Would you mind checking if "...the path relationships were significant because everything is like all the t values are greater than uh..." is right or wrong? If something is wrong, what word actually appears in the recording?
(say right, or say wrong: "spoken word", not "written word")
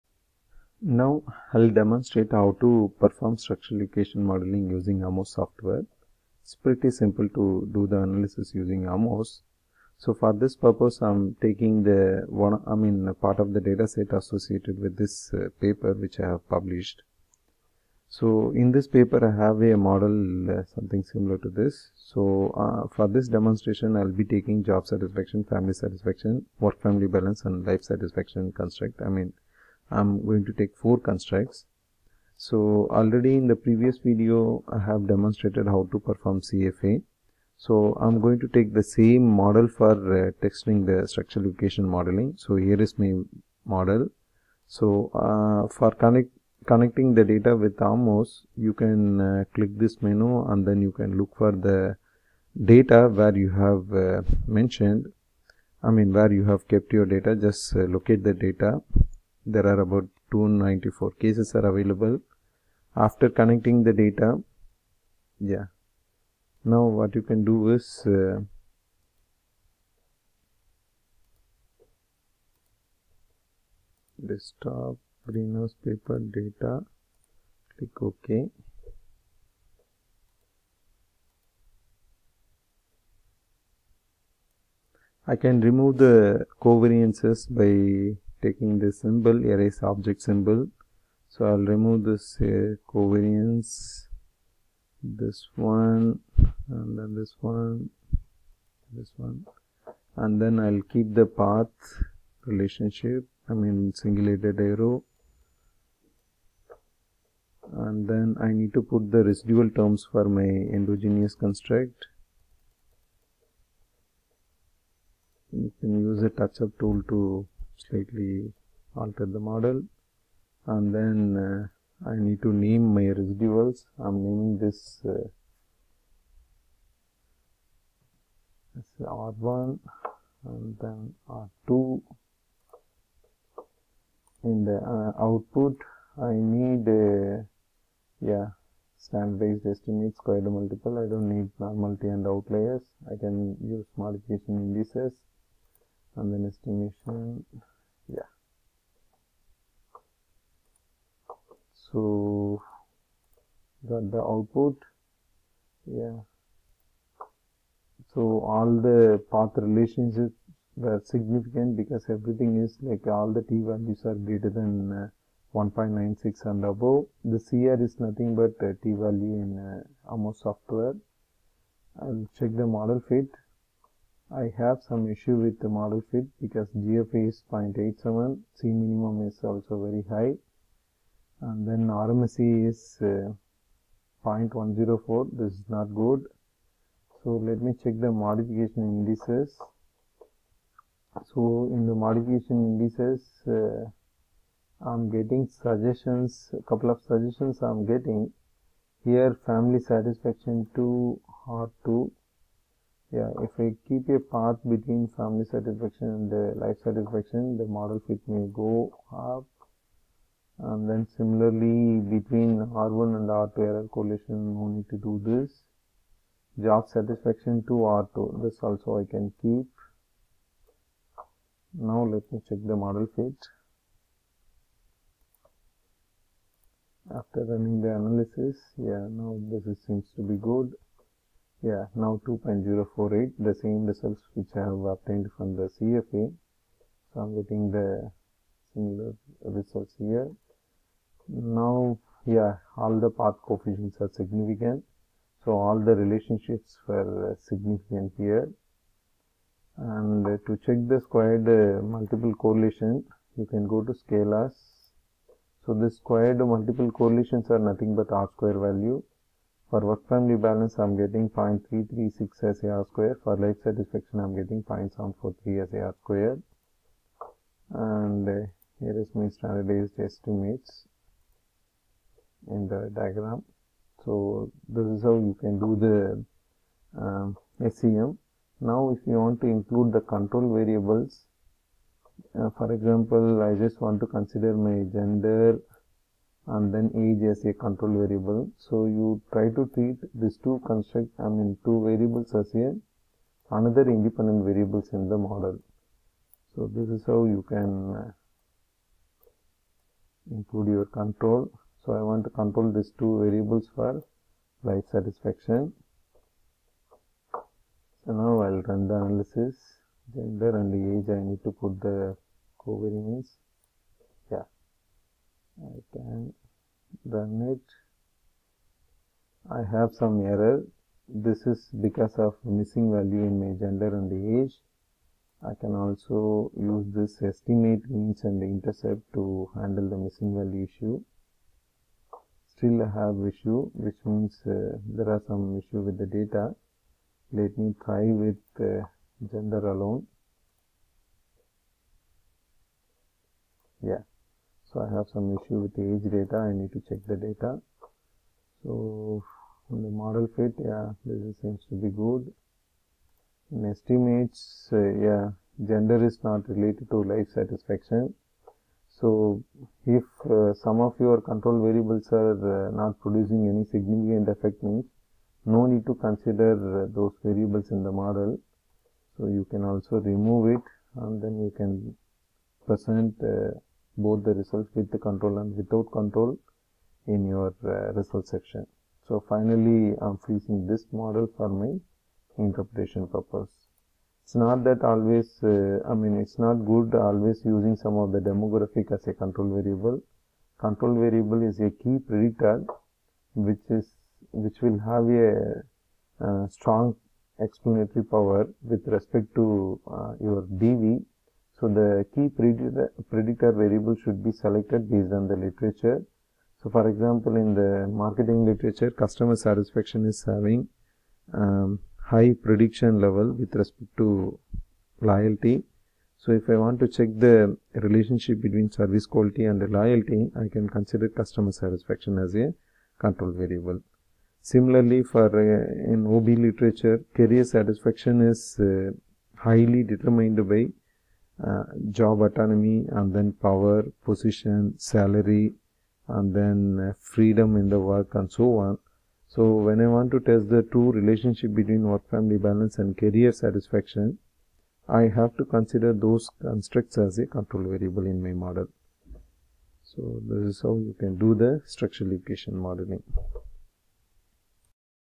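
right.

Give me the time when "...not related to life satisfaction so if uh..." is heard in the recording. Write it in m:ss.
5:56.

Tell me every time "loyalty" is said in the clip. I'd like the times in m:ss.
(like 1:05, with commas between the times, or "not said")
6:55, 6:59.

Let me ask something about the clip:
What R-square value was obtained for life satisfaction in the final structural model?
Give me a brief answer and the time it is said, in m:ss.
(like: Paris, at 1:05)
0.743, at 4:24.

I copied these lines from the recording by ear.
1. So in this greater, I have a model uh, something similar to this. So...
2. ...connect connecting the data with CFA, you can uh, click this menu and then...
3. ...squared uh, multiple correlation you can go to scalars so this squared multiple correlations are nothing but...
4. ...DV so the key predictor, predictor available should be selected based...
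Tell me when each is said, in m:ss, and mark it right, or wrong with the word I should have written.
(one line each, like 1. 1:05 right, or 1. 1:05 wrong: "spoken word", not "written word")
1. 0:18 wrong: "paper", not "greater"
2. 0:45 wrong: "AMOS", not "CFA"
3. 4:11 right
4. 6:40 wrong: "variable", not "available".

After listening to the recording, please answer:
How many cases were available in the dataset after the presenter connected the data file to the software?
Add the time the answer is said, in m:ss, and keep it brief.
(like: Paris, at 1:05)
294, at 1:00.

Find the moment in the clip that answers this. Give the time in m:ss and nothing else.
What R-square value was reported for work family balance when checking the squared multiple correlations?
4:21.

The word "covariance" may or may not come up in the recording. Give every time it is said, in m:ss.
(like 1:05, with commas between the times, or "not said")
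1:26, 1:32, 5:12.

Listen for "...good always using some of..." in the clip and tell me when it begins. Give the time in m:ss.
6:26.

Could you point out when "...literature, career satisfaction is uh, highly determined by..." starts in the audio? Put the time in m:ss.
7:06.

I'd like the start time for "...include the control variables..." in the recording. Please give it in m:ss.
4:39.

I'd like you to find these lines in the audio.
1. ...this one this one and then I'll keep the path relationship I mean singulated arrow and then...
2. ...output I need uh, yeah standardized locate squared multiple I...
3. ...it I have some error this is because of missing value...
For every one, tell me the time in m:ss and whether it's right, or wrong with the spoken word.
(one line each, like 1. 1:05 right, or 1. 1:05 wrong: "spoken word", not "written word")
1. 1:37 right
2. 2:15 wrong: "estimate", not "locate"
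3. 5:17 right.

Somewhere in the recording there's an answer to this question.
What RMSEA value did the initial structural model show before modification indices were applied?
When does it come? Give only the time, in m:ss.
3:04.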